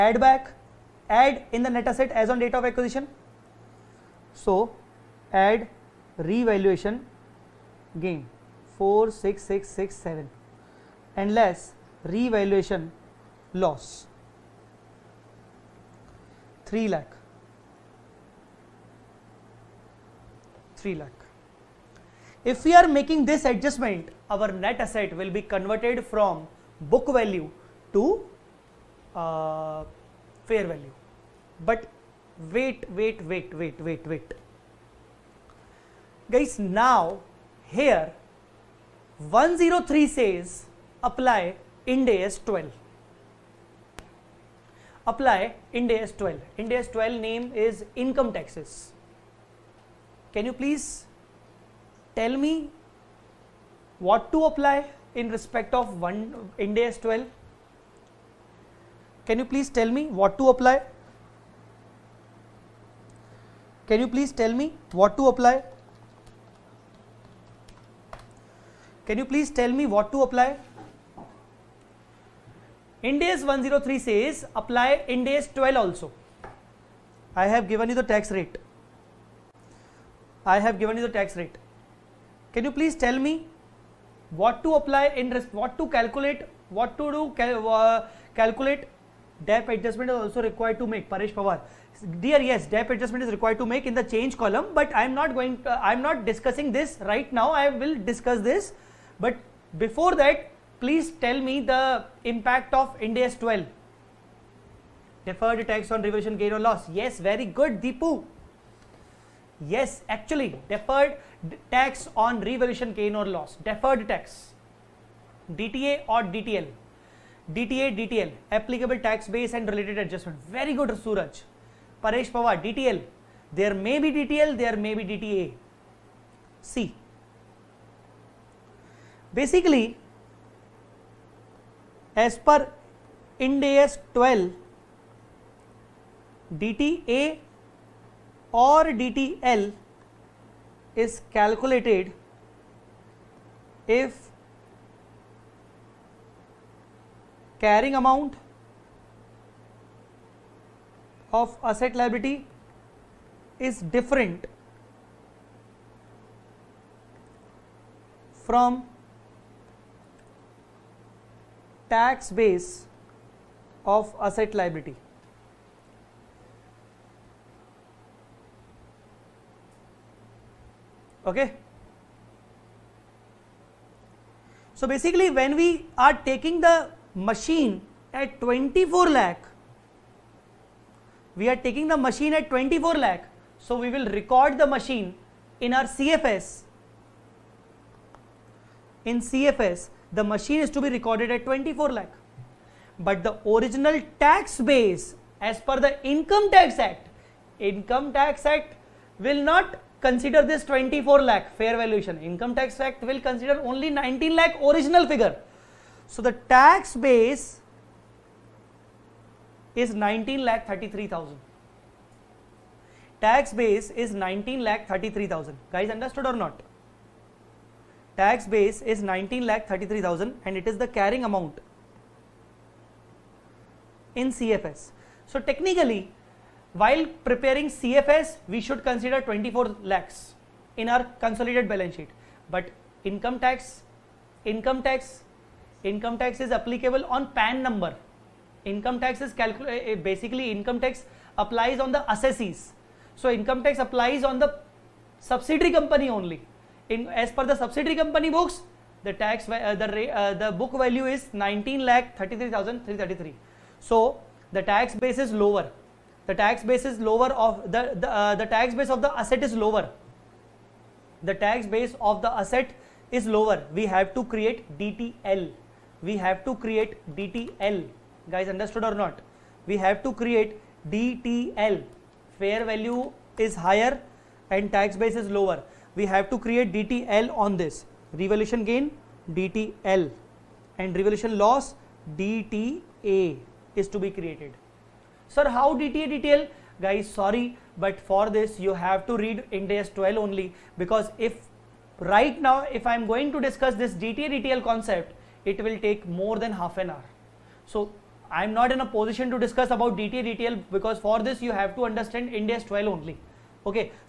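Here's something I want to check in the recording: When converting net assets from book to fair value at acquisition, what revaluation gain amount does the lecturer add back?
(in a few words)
46667.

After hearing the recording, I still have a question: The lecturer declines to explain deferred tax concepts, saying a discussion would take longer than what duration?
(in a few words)
half an hour.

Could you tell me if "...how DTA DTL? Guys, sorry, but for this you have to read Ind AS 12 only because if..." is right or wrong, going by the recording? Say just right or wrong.
right.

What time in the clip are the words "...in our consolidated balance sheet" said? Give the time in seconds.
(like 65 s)
230 s.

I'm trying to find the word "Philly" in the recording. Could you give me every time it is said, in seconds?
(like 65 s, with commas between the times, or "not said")
not said.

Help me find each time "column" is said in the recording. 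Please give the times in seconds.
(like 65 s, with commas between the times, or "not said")
94 s.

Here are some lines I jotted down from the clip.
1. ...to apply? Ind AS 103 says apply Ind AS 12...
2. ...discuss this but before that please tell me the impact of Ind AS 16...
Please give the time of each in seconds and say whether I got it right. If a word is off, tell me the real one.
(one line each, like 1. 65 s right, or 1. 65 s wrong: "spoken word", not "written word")
1. 70 s right
2. 97 s wrong: "12", not "16".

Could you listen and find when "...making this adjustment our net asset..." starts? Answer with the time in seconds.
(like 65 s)
22 s.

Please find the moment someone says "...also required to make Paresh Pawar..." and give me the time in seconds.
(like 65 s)
90 s.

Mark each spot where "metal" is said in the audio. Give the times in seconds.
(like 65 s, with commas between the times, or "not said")
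not said.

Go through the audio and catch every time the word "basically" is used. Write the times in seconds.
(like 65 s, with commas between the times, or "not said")
129 s, 174 s, 239 s.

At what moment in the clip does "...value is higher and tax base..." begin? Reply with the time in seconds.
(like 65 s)
272 s.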